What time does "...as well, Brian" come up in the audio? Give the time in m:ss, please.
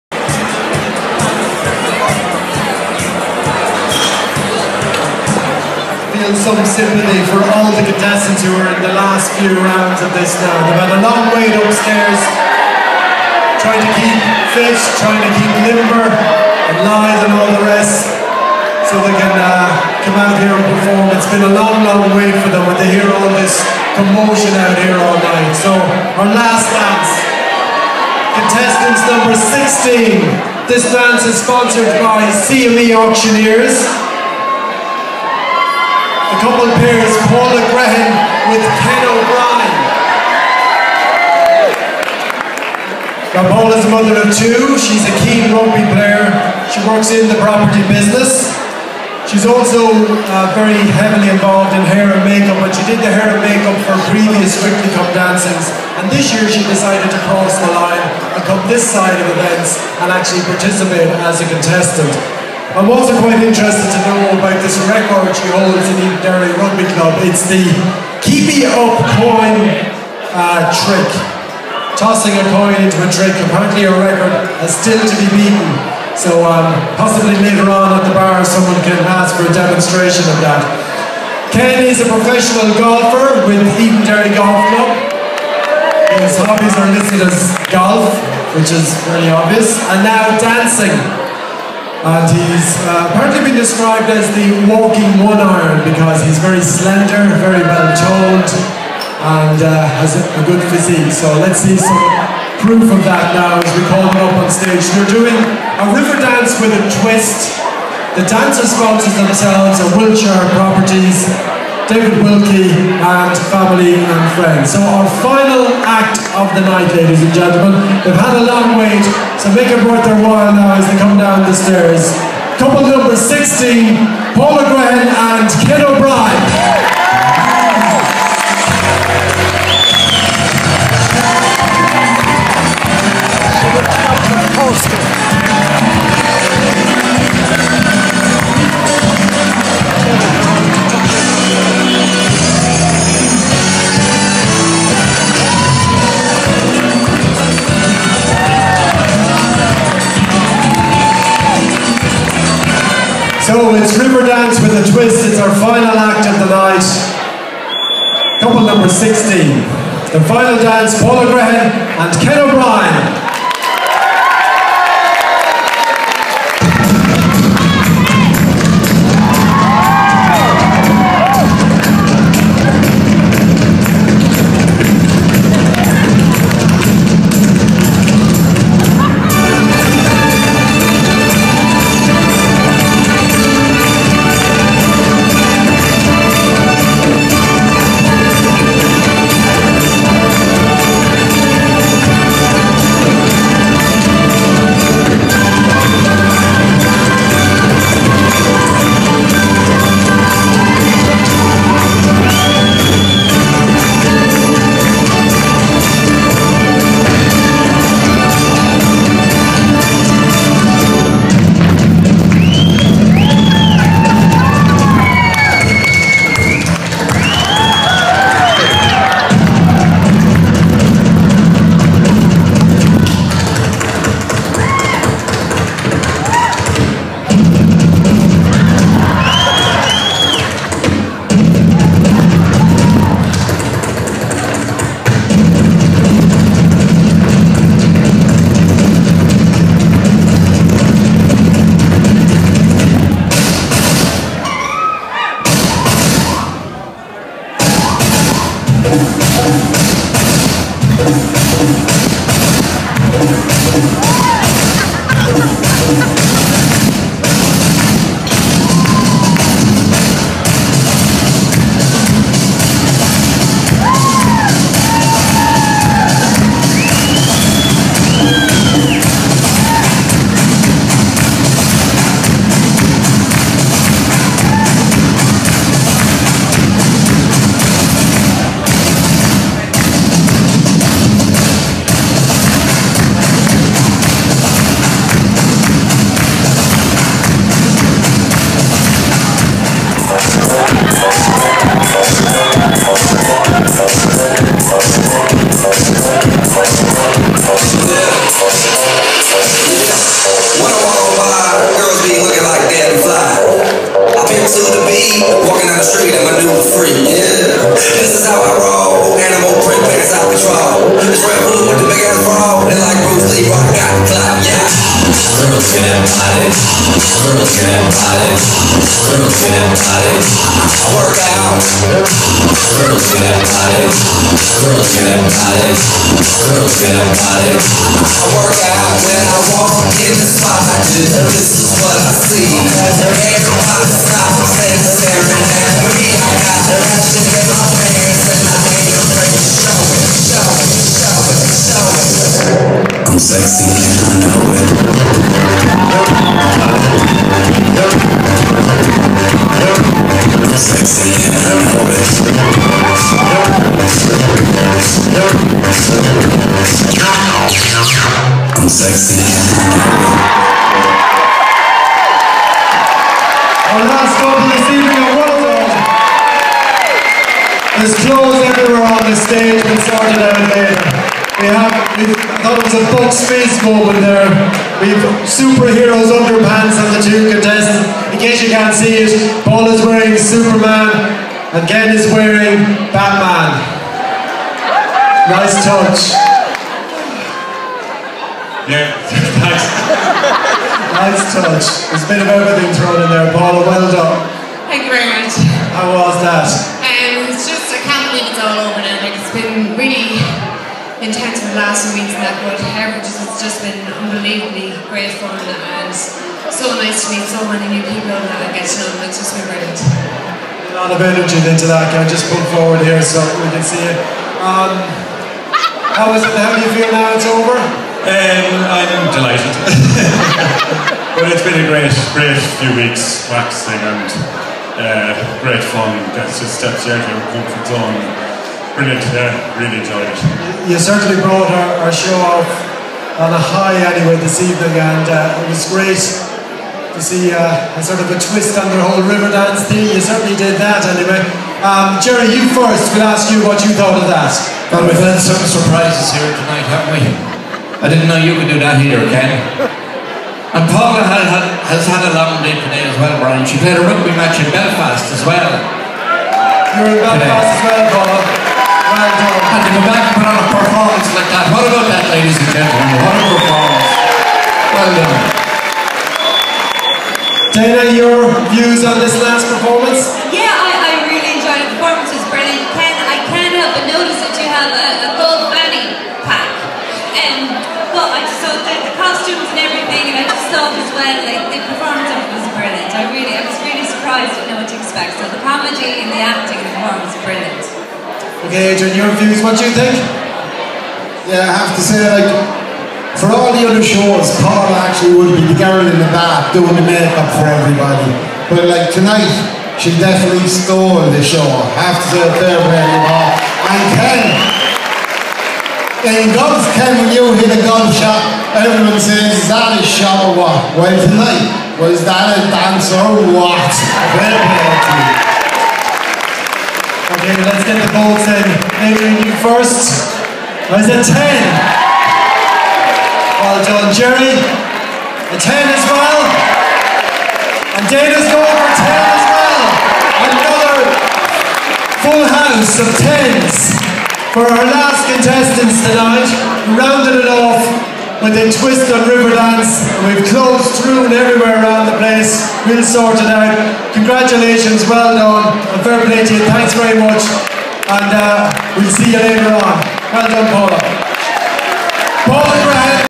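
7:32.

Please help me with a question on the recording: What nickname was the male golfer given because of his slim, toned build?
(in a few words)
the walking one iron.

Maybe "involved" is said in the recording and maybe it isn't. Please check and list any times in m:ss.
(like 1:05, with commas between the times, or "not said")
0:51.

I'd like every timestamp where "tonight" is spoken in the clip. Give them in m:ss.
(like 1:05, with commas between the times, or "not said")
7:26, 8:18, 8:30, 8:55.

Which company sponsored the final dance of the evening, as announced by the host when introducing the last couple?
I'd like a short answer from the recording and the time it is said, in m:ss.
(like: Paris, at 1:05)
CME Auctioneers, at 0:32.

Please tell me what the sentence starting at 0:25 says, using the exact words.
So, our last dance, contestants number 16.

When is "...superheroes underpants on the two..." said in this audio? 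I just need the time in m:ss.
6:15.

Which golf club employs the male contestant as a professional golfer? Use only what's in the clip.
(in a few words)
Edenderry Golf Club.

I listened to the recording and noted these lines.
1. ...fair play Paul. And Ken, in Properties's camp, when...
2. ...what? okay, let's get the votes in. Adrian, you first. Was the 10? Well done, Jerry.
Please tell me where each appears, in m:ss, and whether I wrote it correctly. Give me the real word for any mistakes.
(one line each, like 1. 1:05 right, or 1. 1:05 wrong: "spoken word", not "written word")
1. 8:22 wrong: "God", not "Properties"
2. 8:33 right.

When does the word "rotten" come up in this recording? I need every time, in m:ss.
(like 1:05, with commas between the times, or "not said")
not said.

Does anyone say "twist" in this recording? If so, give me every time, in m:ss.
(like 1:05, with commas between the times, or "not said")
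1:47, 7:18, 8:58.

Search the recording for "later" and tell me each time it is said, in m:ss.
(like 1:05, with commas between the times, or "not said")
1:17, 6:10, 9:09.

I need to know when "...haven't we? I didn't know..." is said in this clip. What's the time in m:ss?
7:26.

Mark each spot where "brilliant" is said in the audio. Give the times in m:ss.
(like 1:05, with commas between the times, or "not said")
6:49, 7:08, 7:52, 8:02, 8:07.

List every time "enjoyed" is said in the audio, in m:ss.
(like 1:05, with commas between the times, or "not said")
7:09, 7:51.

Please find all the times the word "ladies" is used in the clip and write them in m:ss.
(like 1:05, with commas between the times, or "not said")
1:56, 7:42.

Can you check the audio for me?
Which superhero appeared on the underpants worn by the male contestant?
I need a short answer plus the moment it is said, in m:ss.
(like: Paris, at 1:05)
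Batman, at 6:22.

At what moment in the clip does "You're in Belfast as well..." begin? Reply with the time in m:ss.
7:36.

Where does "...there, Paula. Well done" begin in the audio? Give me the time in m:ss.
6:33.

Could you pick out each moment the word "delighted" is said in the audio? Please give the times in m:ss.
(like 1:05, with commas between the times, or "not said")
6:59.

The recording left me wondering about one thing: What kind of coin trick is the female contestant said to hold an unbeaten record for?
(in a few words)
keepy up.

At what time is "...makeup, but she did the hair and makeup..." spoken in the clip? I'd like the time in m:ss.
0:52.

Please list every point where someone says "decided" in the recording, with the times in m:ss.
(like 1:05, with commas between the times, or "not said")
0:56.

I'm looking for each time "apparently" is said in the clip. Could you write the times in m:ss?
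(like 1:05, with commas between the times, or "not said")
1:13, 1:33.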